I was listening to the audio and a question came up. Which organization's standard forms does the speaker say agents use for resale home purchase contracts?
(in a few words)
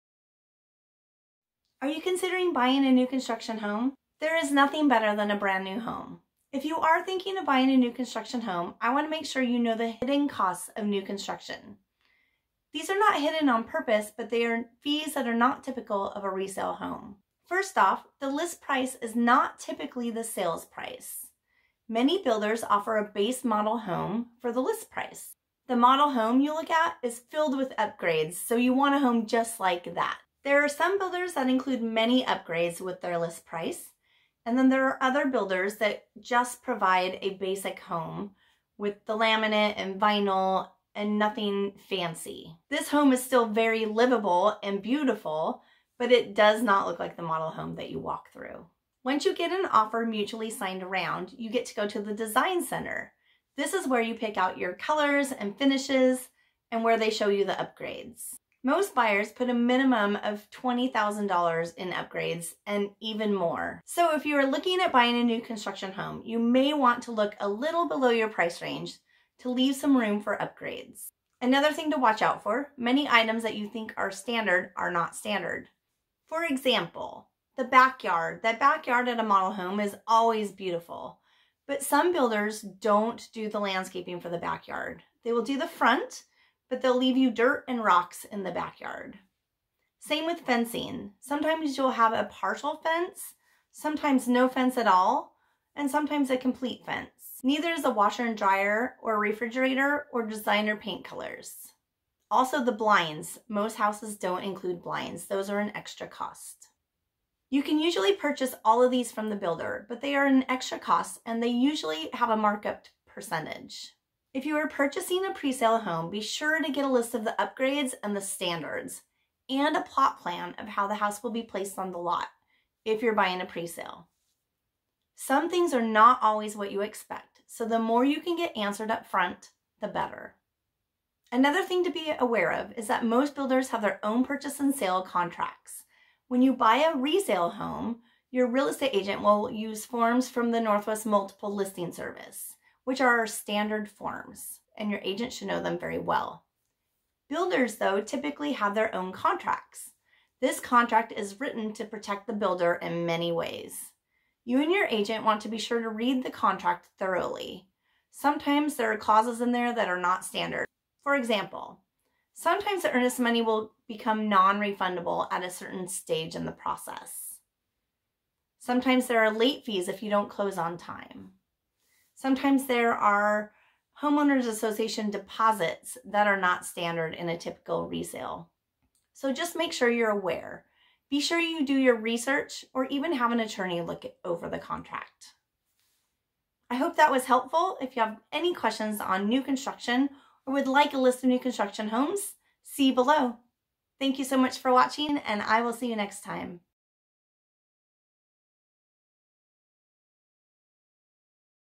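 Northwest Multiple Listing Service.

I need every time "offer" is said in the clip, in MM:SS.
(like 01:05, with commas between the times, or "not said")
00:22, 00:49.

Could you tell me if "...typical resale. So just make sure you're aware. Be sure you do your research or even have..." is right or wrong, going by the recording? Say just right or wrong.
right.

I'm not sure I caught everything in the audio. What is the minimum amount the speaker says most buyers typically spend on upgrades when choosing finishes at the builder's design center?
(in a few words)
$20,000.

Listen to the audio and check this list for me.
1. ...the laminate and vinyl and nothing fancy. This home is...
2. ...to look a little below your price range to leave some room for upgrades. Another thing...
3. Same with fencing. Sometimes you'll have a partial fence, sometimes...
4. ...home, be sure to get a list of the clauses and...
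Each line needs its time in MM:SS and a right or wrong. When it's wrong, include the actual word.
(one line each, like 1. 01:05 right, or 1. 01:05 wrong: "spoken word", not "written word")
1. 00:39 right
2. 01:07 right
3. 01:29 right
4. 01:55 wrong: "upgrades", not "clauses".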